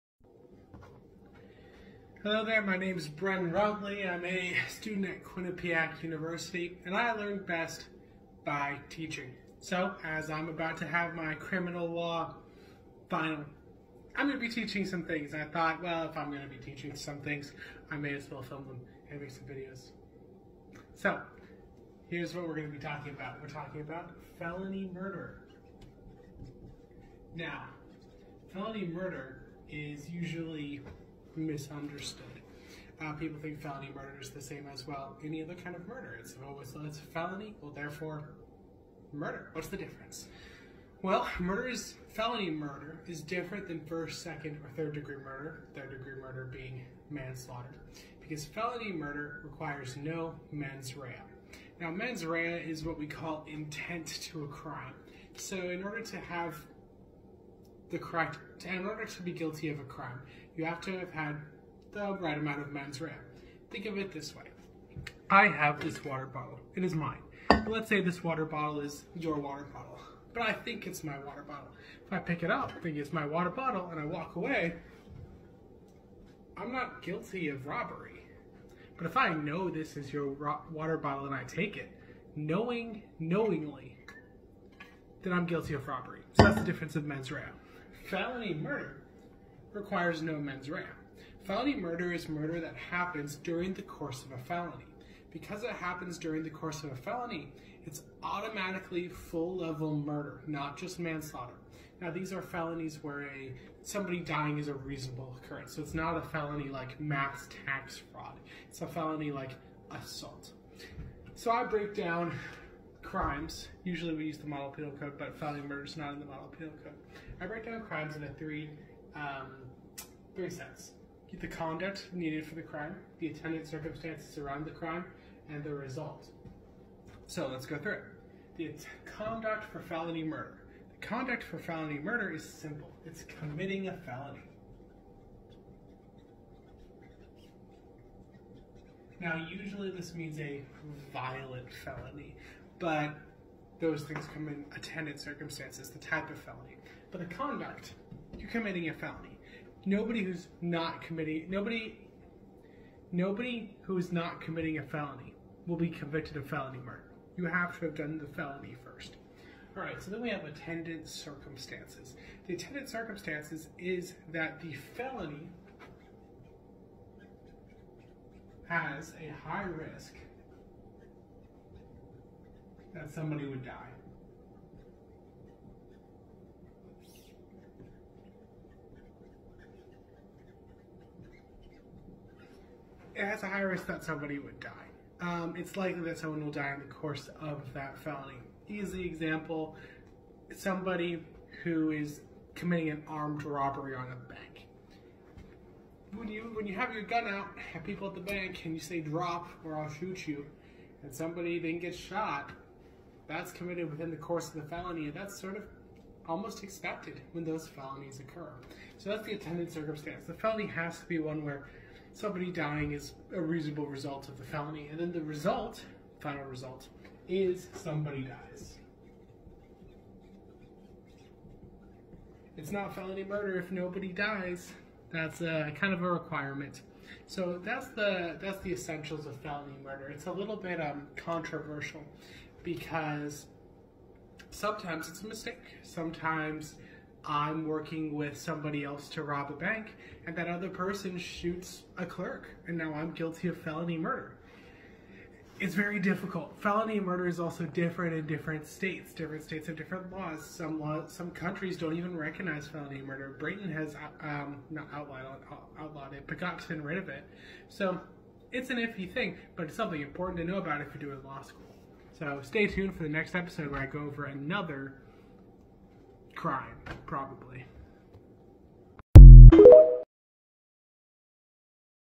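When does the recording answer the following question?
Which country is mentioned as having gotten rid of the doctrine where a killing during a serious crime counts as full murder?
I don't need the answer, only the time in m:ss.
4:13.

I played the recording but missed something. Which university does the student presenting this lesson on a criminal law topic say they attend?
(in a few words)
Quinnipiac University.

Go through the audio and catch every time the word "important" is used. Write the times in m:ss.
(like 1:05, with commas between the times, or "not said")
4:20.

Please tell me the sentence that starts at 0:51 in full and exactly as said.
Now, mens rea is what we call intent to a crime.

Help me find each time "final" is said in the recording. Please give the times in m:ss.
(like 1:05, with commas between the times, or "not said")
0:13, 3:36.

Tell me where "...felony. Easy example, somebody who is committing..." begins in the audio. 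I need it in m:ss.
3:07.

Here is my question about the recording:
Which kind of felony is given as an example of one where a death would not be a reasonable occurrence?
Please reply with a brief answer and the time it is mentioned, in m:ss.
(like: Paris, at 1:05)
mass tax fraud, at 1:46.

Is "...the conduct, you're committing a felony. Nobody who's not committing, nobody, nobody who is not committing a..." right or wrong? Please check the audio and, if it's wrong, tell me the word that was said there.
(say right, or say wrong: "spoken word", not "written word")
right.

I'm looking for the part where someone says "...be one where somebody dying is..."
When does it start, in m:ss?
3:31.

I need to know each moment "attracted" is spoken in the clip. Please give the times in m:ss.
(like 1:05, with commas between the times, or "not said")
not said.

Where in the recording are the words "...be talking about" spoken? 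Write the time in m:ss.
0:22.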